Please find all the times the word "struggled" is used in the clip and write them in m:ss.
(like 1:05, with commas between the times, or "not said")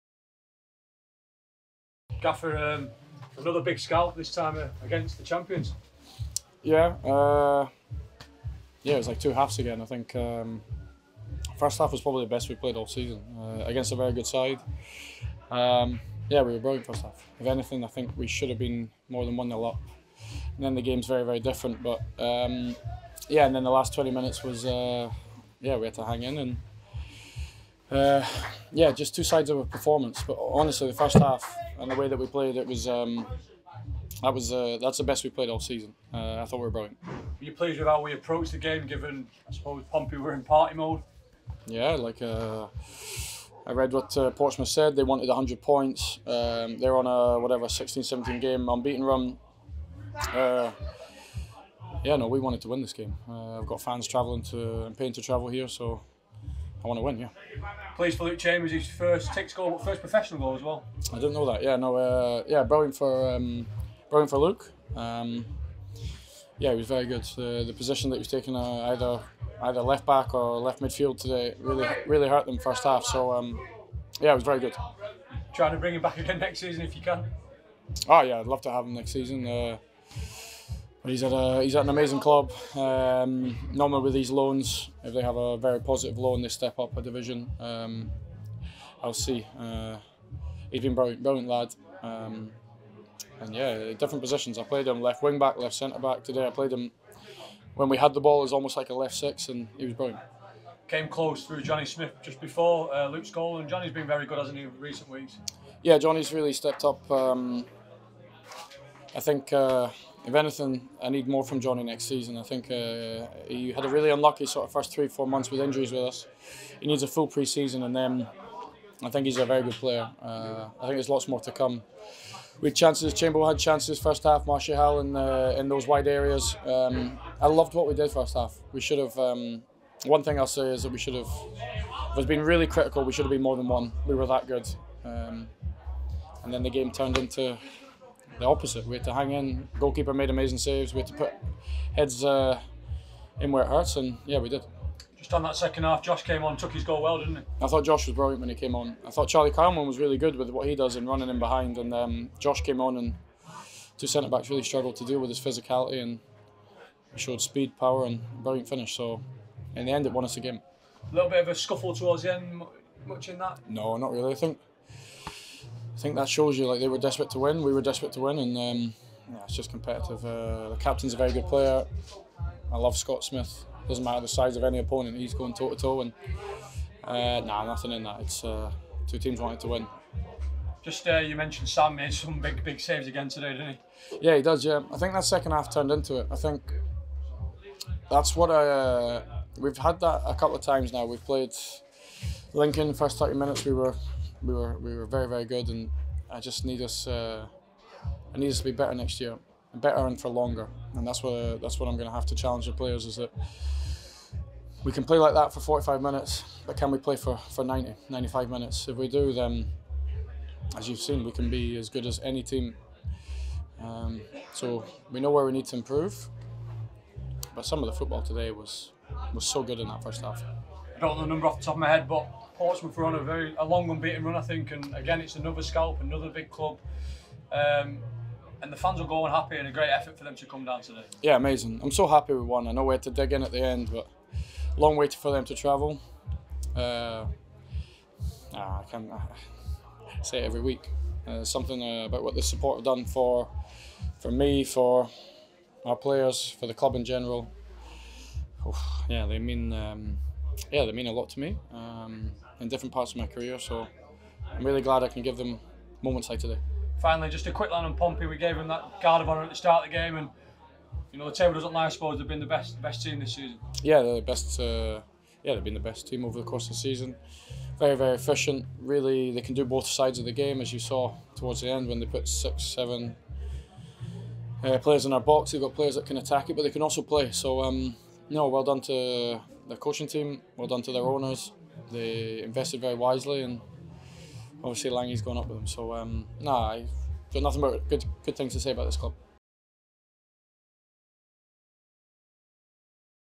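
2:34.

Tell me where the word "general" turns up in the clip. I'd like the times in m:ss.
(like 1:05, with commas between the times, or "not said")
4:07.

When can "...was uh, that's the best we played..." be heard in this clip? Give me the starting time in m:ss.
0:34.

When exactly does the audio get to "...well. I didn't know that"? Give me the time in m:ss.
1:00.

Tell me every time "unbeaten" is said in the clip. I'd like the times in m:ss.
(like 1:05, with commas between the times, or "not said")
0:48, 3:43.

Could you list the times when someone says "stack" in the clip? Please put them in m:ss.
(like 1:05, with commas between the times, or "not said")
not said.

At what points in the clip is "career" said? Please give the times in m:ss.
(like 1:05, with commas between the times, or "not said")
4:13.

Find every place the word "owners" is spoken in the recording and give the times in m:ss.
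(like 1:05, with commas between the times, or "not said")
4:41.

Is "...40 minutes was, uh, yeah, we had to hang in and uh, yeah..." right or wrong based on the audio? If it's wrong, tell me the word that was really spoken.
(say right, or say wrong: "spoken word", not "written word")
wrong: "20", not "40".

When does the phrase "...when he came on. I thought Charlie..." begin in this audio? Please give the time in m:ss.
2:28.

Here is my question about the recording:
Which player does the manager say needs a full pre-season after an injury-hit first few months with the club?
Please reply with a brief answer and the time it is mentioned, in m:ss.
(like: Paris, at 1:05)
Johnny Smith, at 1:41.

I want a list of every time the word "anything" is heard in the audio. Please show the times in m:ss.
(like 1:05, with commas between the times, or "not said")
0:17, 1:50.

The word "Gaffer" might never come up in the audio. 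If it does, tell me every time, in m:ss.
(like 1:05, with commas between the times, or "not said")
0:02.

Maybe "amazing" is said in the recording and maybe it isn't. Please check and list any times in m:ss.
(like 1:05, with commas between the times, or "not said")
1:21, 2:20, 3:51.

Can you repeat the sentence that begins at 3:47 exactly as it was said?
Um, and the fans are going happy.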